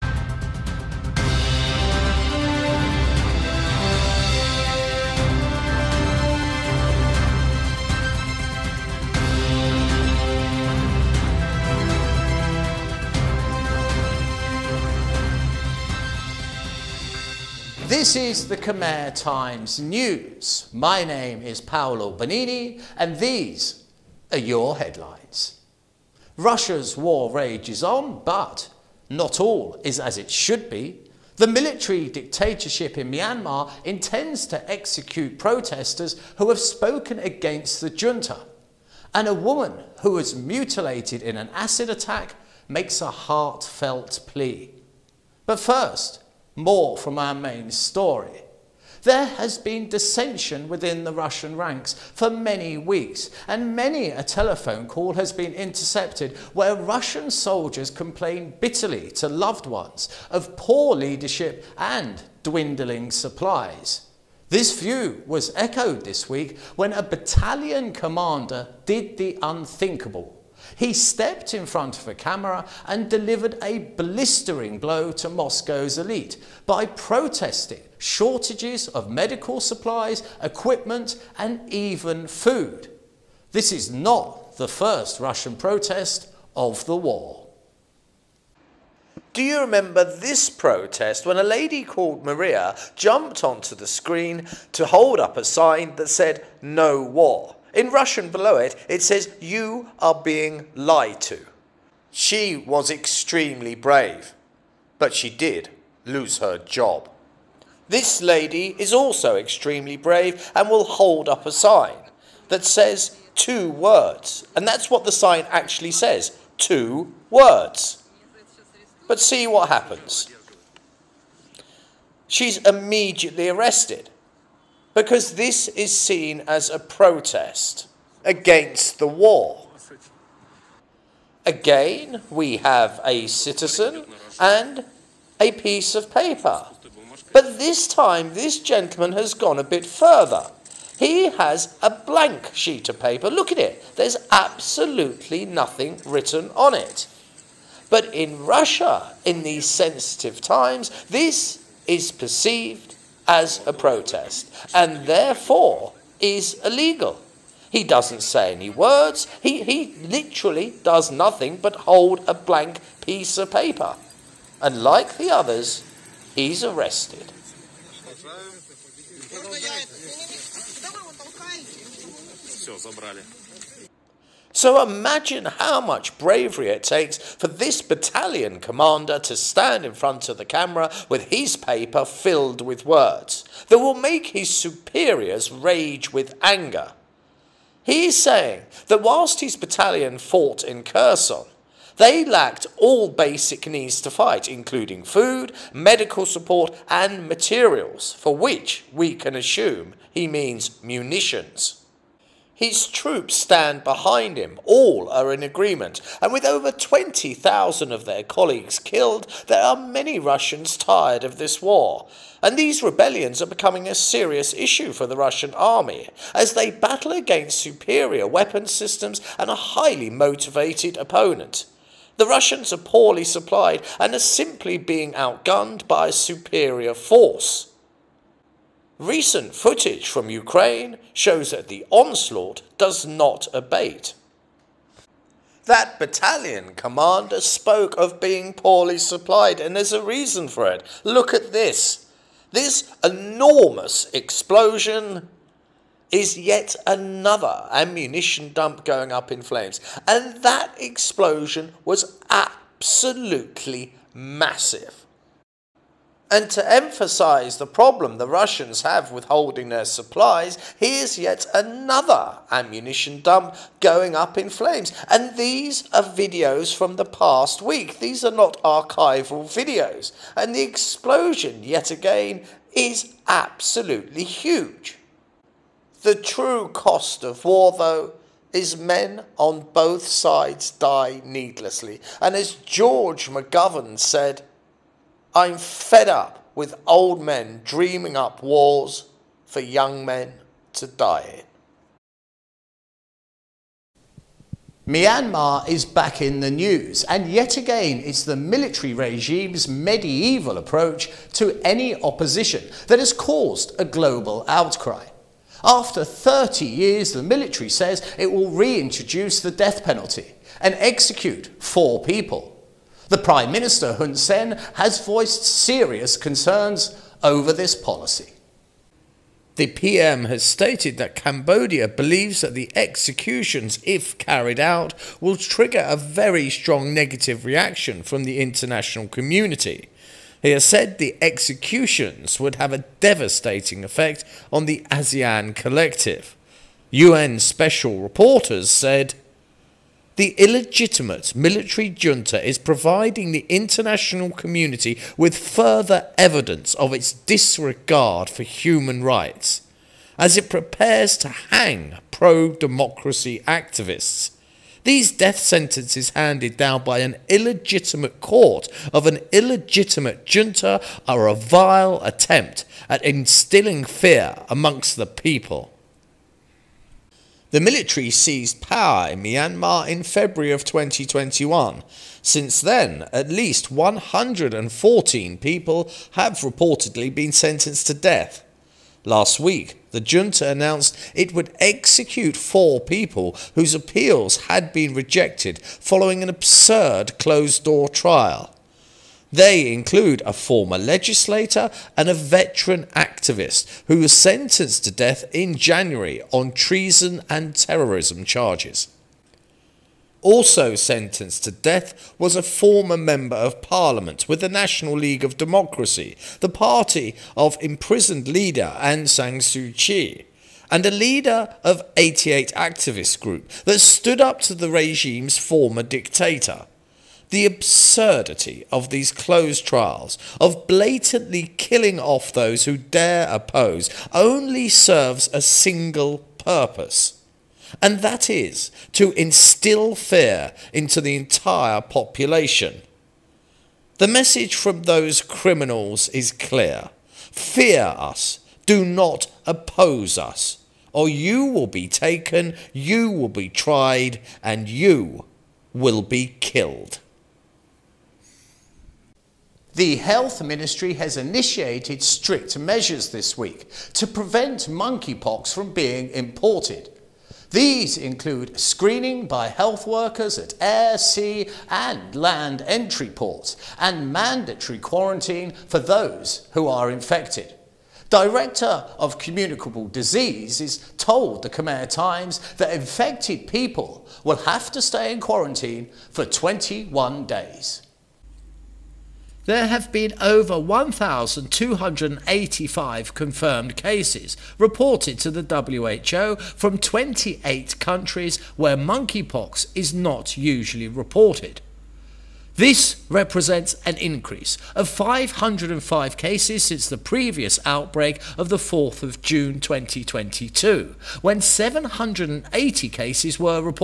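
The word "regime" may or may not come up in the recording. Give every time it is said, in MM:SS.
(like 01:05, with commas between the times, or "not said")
04:58, 06:54.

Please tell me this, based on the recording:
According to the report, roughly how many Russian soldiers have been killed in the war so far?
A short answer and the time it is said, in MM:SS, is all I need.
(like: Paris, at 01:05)
20,000, at 03:26.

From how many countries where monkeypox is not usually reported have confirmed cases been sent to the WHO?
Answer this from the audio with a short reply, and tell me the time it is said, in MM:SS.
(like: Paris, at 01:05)
28, at 08:06.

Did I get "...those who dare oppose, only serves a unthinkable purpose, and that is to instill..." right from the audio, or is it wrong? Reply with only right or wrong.
wrong.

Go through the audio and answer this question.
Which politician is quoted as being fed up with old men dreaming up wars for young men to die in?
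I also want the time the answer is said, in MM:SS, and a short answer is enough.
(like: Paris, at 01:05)
George McGovern, at 04:42.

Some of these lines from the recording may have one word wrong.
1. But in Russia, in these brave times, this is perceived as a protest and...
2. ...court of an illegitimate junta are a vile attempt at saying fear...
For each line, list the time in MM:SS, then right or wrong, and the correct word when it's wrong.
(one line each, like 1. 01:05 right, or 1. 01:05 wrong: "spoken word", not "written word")
1. 02:27 wrong: "sensitive", not "brave"
2. 05:58 wrong: "instilling", not "saying".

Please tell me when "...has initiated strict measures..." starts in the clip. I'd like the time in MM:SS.
07:30.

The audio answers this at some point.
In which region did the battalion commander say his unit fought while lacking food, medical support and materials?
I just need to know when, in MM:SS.
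03:10.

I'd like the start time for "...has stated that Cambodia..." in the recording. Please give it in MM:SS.
05:20.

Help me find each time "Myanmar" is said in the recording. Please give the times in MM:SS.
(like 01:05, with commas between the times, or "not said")
00:33, 04:54, 06:09.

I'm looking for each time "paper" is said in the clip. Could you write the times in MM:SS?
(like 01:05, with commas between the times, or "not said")
02:16, 02:22, 02:43, 03:01.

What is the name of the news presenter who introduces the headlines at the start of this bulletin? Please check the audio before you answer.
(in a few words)
Paolo Bonini.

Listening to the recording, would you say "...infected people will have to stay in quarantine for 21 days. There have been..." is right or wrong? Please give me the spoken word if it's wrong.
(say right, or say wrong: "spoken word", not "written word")
right.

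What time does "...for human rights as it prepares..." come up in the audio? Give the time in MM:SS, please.
05:48.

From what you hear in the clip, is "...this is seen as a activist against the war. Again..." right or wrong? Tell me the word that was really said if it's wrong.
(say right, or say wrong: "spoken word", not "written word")
wrong: "protest", not "activist".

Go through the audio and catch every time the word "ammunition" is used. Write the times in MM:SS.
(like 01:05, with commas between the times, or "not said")
04:07, 04:22.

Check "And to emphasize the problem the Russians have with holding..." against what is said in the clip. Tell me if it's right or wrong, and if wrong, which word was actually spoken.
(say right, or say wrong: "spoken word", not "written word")
right.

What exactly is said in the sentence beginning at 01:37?
In Russian below it, it says, You are being lied to.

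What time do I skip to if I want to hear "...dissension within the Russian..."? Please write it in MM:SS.
00:49.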